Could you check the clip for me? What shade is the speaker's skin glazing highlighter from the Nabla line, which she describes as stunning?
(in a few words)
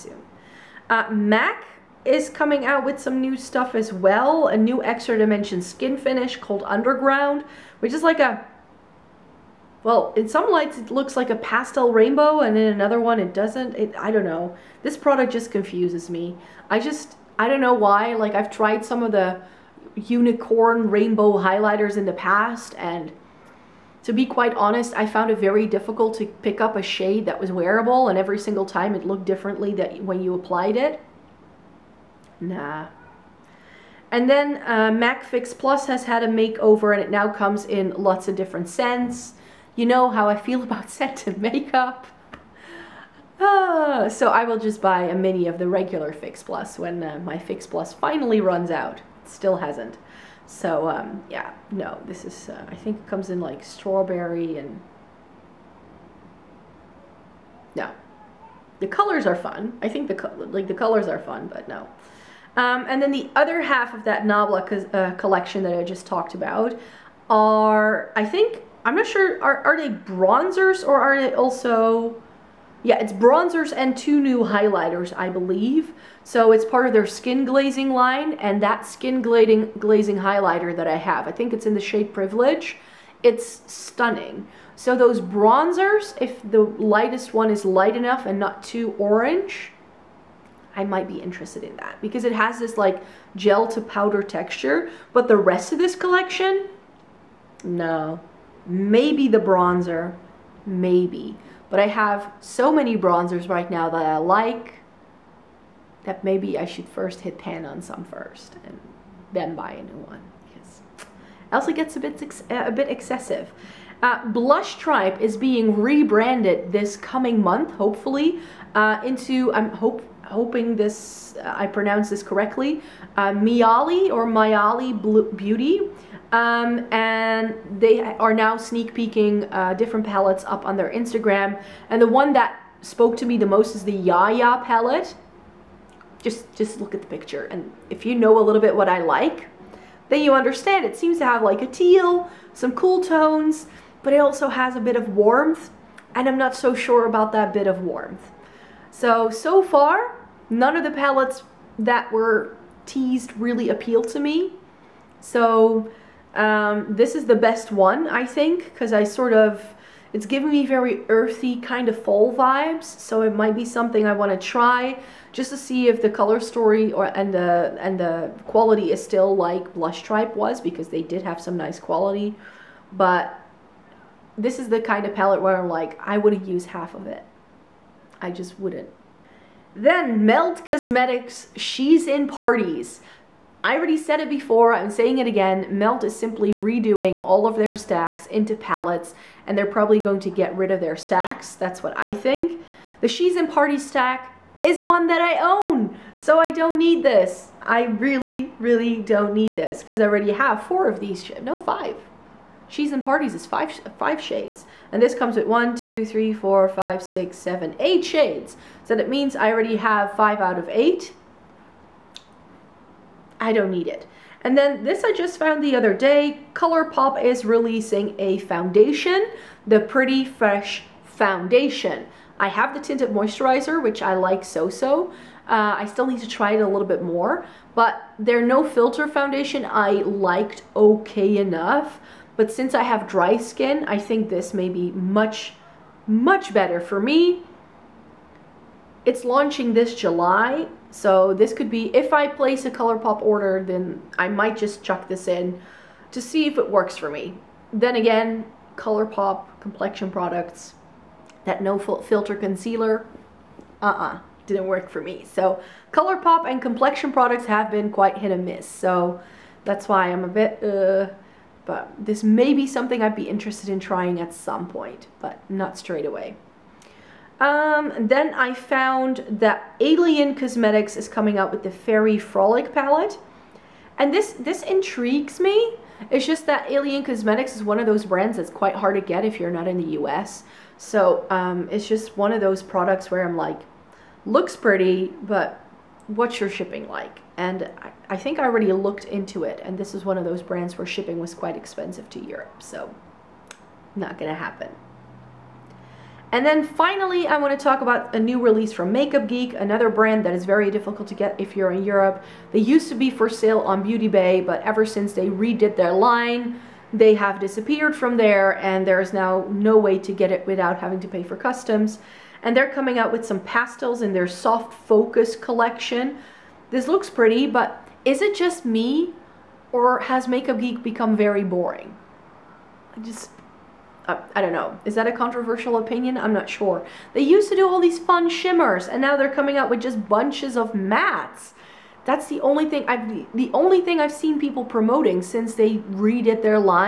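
Privilege.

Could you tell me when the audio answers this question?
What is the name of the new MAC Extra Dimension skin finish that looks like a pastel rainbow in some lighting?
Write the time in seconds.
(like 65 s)
6 s.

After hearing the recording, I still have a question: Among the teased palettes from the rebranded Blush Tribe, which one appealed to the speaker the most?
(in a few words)
Yaya palette.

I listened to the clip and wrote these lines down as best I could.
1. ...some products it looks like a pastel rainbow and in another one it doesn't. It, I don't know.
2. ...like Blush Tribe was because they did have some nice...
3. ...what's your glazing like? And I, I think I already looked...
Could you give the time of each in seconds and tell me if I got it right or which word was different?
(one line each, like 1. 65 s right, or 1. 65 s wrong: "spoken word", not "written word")
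1. 10 s wrong: "lights", not "products"
2. 169 s right
3. 286 s wrong: "shipping", not "glazing".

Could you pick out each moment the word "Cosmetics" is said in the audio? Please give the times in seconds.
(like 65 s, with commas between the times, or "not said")
180 s, 270 s, 277 s.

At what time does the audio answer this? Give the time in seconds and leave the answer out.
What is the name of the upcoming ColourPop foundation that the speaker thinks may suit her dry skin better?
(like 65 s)
219 s.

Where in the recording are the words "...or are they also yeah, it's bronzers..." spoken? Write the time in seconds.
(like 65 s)
70 s.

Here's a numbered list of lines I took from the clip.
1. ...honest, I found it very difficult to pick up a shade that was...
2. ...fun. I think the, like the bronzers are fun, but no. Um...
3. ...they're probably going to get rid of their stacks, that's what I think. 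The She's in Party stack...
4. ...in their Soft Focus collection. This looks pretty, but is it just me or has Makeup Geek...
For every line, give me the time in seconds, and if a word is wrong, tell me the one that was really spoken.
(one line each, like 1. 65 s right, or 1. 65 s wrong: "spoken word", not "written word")
1. 24 s right
2. 59 s wrong: "colors", not "bronzers"
3. 189 s right
4. 314 s right.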